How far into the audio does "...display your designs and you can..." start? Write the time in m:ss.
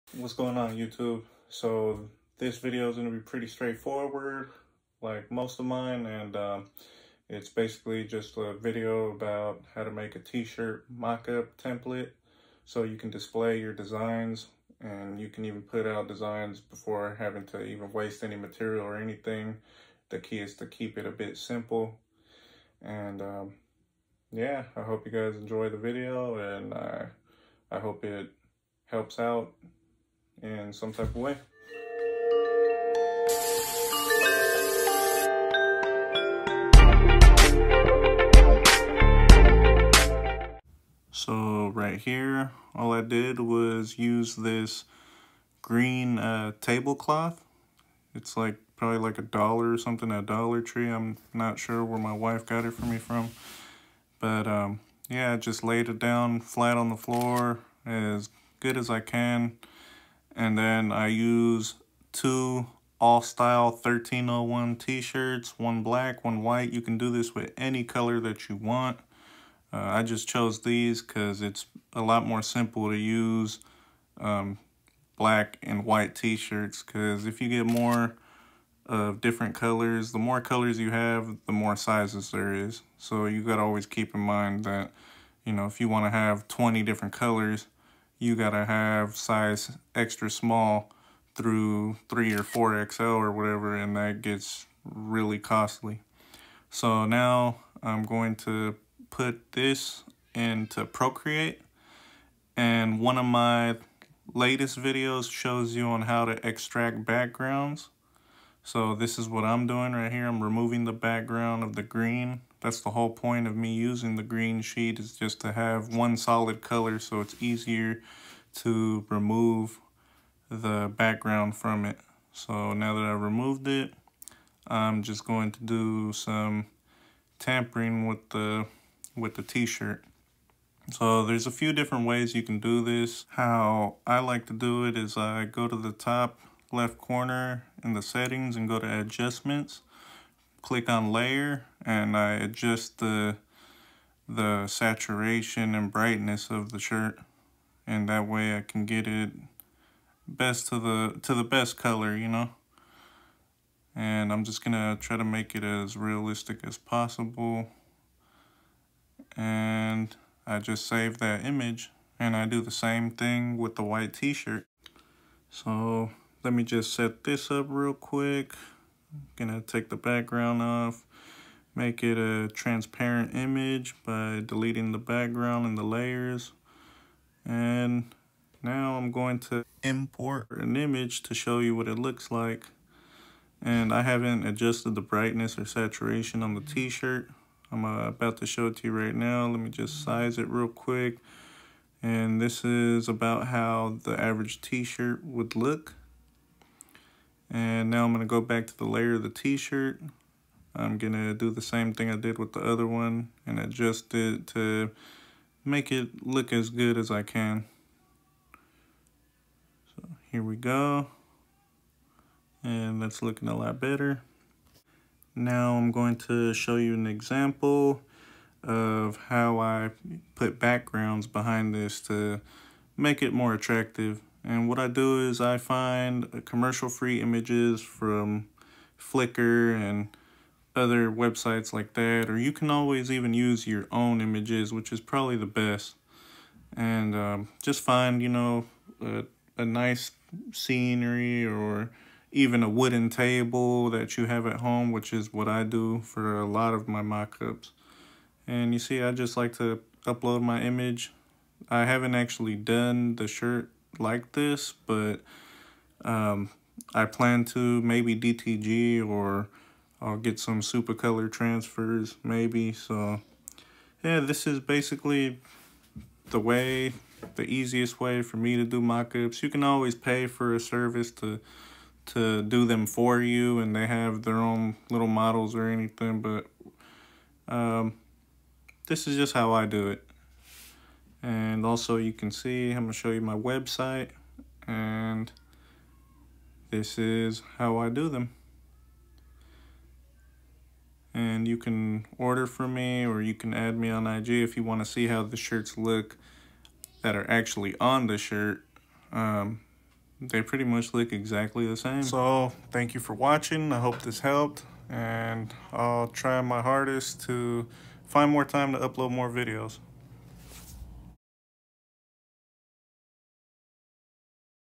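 0:13.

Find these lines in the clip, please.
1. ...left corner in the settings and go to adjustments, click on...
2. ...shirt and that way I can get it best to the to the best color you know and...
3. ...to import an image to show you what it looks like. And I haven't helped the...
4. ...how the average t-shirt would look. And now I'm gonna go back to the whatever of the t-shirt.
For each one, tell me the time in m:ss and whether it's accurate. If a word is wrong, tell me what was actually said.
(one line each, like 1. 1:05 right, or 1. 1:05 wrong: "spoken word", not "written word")
1. 2:16 right
2. 2:26 right
3. 2:59 wrong: "adjusted", not "helped"
4. 3:13 wrong: "layer", not "whatever".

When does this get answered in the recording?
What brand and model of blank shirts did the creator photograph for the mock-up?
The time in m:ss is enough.
1:03.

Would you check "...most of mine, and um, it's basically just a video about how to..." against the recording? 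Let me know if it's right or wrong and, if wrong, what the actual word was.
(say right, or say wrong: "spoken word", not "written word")
right.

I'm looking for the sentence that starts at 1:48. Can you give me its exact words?
So this is what I'm doing right here.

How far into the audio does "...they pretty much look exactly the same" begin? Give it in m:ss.
5:00.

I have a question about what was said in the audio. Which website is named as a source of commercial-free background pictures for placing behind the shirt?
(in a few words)
Flickr.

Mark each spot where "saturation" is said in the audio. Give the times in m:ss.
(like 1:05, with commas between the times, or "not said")
2:24, 3:05.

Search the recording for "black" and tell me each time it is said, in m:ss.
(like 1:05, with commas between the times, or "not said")
1:05, 1:15.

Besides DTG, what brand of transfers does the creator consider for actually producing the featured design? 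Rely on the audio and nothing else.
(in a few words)
Supacolor.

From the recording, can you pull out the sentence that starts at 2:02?
So now that I removed it, I'm just going to do some tampering with the with the t-shirt.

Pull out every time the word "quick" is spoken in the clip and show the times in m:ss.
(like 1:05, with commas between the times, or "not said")
2:47, 3:10.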